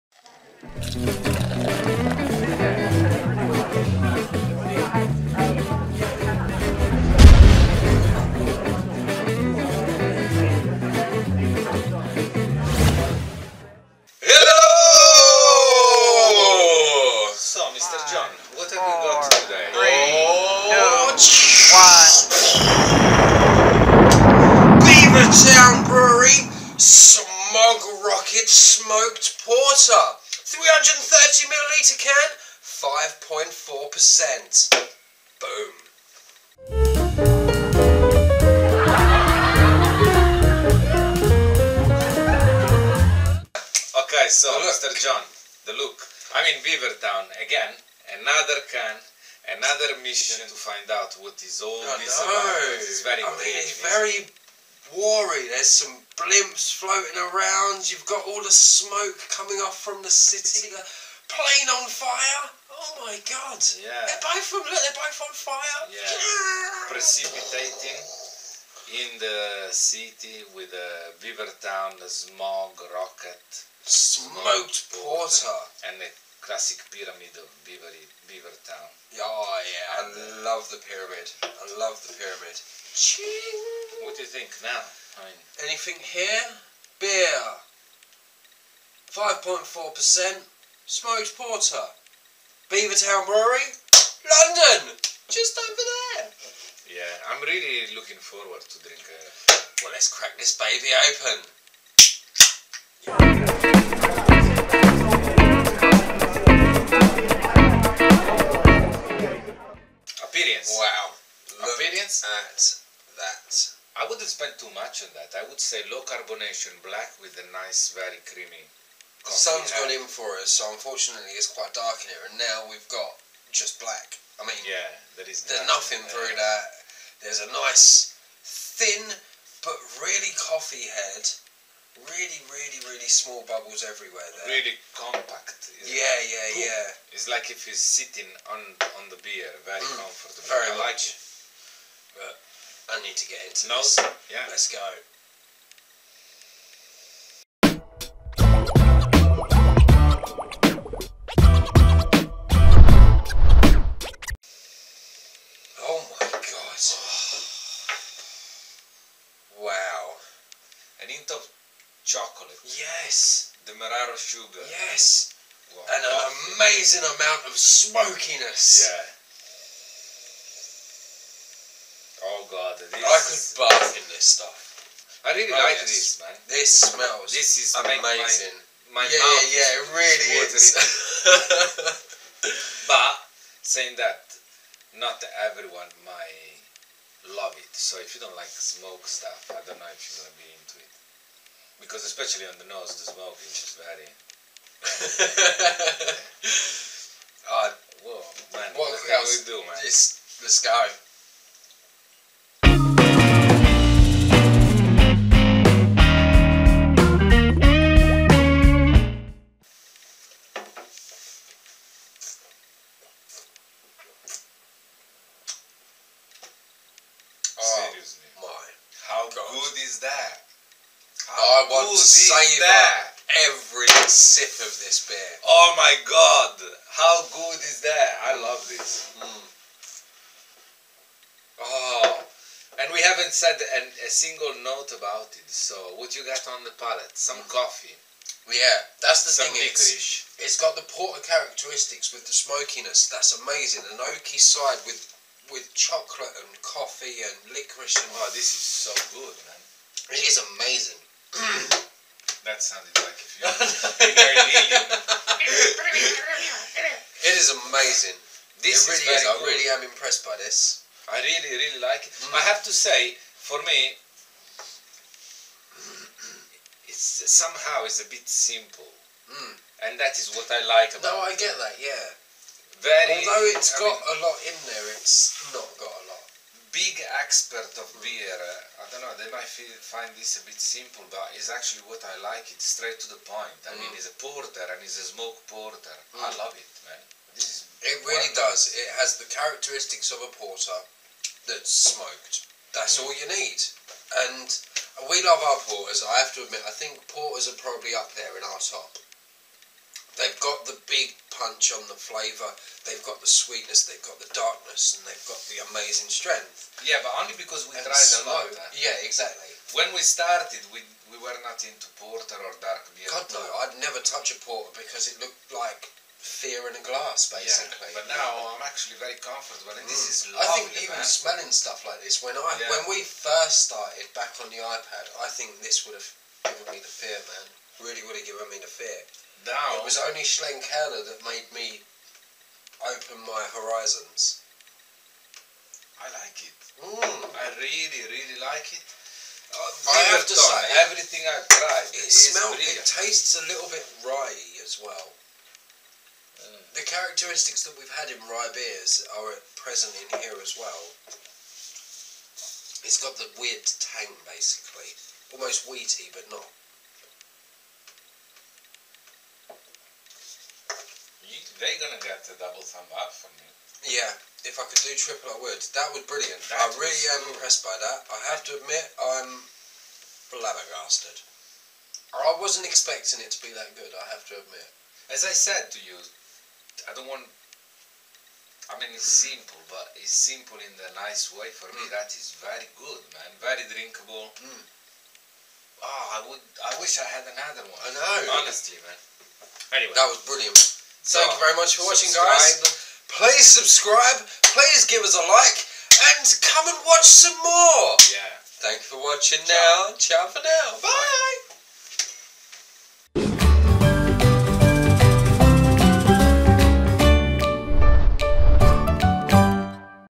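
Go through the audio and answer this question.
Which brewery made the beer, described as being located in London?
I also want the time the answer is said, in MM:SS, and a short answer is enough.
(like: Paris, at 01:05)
Beavertown Brewery, at 01:32.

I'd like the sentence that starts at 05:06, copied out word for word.
Yeah, but only because we and tried slow.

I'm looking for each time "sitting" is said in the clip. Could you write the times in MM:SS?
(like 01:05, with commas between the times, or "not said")
02:17.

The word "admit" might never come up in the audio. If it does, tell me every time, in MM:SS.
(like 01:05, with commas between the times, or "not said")
04:56, 06:08, 06:14.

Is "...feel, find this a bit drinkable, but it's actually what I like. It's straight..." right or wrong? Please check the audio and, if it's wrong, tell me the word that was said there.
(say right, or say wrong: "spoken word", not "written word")
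wrong: "simple", not "drinkable".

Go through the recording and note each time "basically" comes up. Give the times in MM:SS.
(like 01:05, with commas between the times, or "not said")
05:17, 05:54.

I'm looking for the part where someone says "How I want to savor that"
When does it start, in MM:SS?
03:41.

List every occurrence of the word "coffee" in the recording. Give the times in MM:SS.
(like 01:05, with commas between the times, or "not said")
02:10, 03:57, 04:06.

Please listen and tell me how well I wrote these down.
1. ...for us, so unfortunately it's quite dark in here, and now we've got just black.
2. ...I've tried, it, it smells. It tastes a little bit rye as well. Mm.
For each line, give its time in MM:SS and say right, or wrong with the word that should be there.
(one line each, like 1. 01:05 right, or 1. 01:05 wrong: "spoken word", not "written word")
1. 02:00 right
2. 05:41 right.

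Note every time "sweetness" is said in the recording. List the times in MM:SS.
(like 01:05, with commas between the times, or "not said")
05:03.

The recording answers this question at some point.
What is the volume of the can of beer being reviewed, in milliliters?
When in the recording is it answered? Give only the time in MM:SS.
00:30.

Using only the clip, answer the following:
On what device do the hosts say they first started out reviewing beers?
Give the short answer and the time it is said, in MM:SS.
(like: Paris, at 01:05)
iPad, at 05:24.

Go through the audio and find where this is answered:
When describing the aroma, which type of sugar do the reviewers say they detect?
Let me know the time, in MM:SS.
02:43.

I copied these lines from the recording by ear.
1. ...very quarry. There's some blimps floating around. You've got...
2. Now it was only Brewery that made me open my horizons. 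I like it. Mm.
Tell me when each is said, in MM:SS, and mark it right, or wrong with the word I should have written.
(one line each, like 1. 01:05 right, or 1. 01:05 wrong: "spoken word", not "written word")
1. 00:53 right
2. 05:29 wrong: "Schlenkerla", not "Brewery".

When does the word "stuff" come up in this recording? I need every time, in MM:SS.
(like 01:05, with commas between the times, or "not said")
02:54, 03:09, 05:21.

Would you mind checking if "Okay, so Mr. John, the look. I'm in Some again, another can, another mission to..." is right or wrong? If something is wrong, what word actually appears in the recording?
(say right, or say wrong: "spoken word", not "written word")
wrong: "Beavertown", not "Some".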